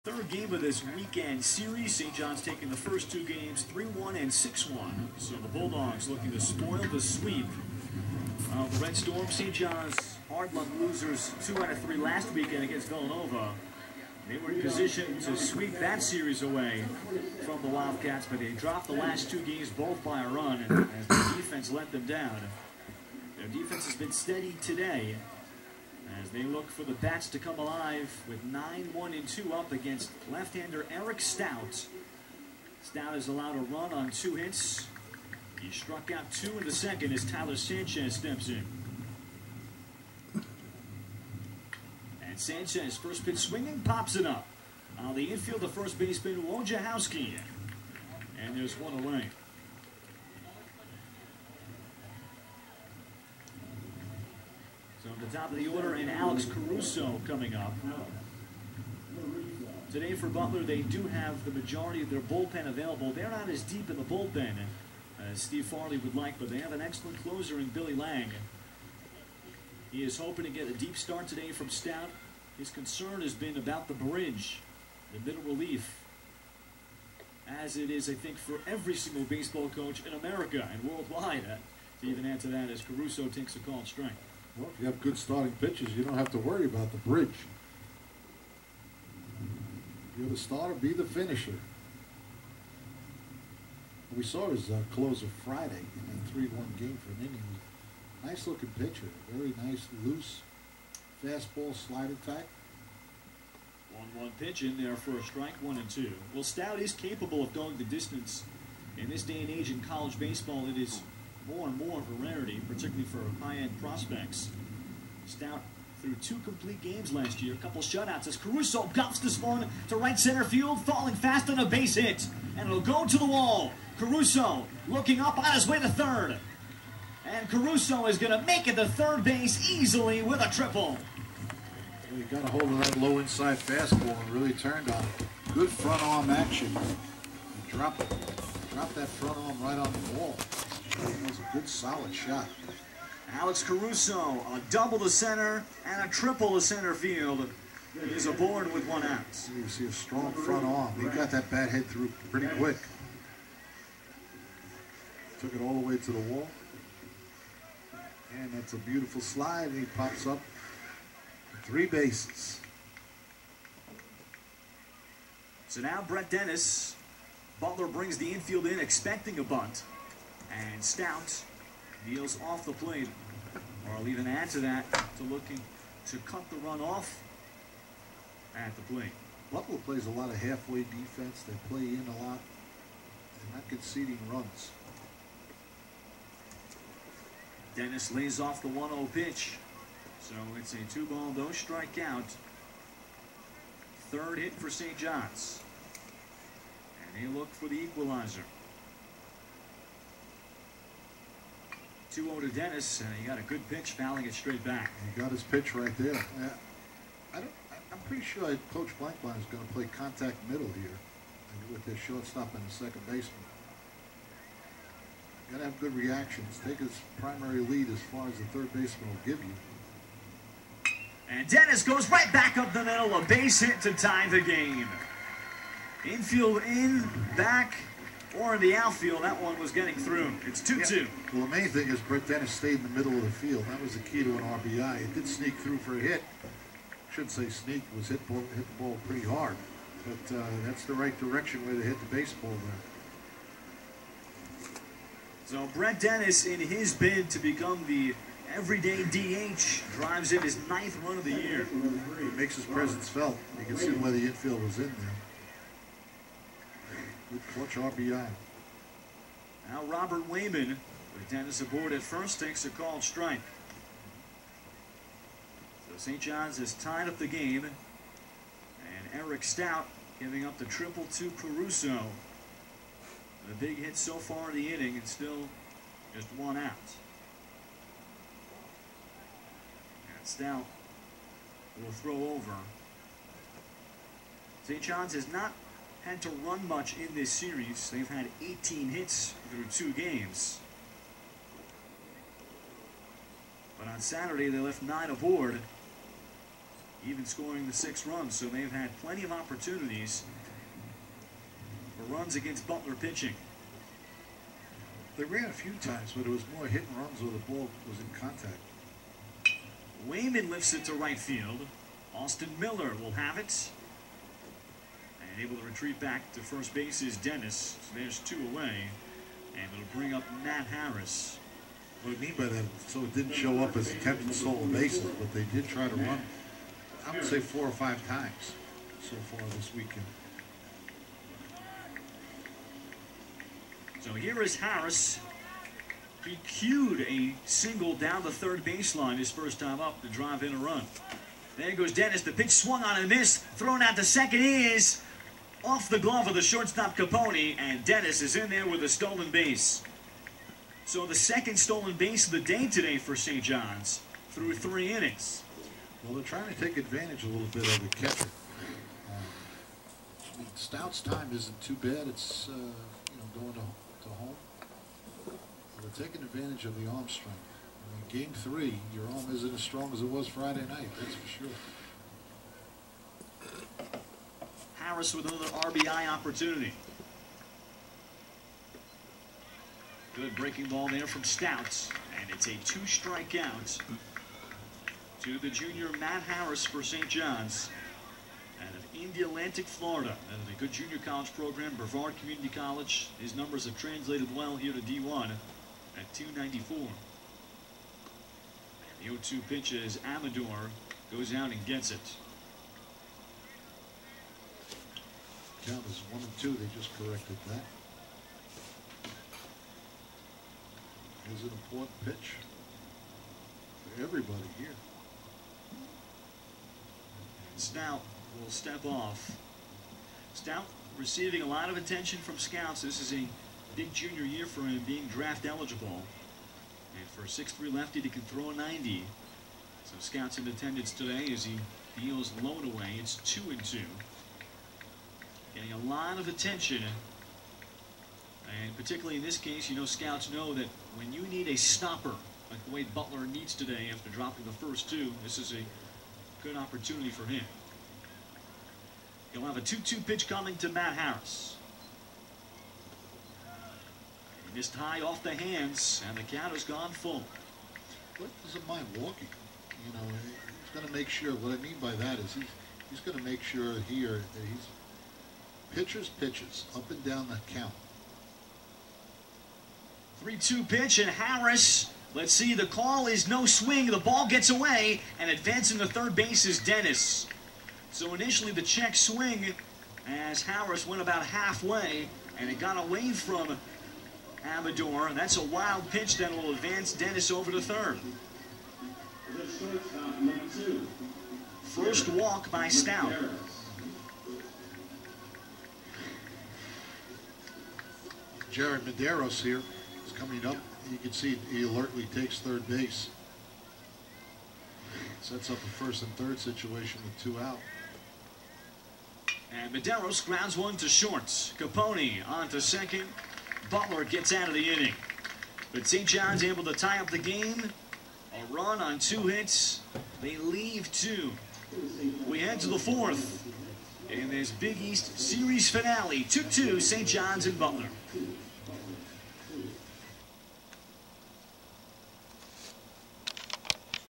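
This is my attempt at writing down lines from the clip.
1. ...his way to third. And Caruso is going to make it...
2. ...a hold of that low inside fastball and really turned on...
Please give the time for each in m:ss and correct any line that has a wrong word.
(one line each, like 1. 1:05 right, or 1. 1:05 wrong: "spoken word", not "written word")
1. 2:05 right
2. 2:12 right.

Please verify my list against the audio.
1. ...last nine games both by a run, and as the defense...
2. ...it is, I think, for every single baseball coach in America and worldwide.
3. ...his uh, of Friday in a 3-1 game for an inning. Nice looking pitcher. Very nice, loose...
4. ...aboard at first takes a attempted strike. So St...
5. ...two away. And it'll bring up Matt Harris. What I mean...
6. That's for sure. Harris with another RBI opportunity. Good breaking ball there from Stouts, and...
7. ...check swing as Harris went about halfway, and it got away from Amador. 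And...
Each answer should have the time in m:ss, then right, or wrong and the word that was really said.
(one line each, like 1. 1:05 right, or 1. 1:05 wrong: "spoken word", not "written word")
1. 0:18 wrong: "two", not "nine"
2. 1:17 right
3. 1:34 right
4. 4:21 wrong: "called", not "attempted"
5. 5:18 right
6. 6:10 right
7. 7:58 right.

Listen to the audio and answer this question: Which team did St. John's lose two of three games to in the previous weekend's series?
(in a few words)
Villanova.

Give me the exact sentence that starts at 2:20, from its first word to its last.
That was a good, solid shot.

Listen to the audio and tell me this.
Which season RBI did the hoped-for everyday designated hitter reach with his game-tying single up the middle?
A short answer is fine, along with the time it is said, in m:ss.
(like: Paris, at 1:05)
9th, at 4:10.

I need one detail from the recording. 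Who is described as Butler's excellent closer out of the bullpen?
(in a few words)
Billy Lang.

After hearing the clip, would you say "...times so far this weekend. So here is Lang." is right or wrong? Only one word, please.
wrong.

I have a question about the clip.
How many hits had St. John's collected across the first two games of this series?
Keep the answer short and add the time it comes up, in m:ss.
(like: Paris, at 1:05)
18, at 4:48.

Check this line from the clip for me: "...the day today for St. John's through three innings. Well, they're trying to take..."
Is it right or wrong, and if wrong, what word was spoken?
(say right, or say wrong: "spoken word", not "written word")
right.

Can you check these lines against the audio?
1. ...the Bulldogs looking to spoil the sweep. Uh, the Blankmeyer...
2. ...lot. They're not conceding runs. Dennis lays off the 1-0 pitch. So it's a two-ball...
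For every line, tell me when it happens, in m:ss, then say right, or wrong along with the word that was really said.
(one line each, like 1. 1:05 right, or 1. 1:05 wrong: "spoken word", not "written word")
1. 0:05 wrong: "Red", not "Blankmeyer"
2. 3:02 right.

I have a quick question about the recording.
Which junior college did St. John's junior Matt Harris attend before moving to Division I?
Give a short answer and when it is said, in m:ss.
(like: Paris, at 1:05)
Brevard Community College, at 6:31.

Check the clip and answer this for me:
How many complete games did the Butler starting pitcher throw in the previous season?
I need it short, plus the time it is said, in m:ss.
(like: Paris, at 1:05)
2, at 1:56.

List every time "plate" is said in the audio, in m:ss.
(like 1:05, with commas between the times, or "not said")
2:52, 2:58.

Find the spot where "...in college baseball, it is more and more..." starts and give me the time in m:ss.
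1:49.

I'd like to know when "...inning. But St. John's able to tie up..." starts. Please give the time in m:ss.
8:34.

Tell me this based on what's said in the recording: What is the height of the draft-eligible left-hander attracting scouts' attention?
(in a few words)
6'3.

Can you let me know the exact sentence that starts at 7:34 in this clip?
He missed high off the hands, and the count has gone full.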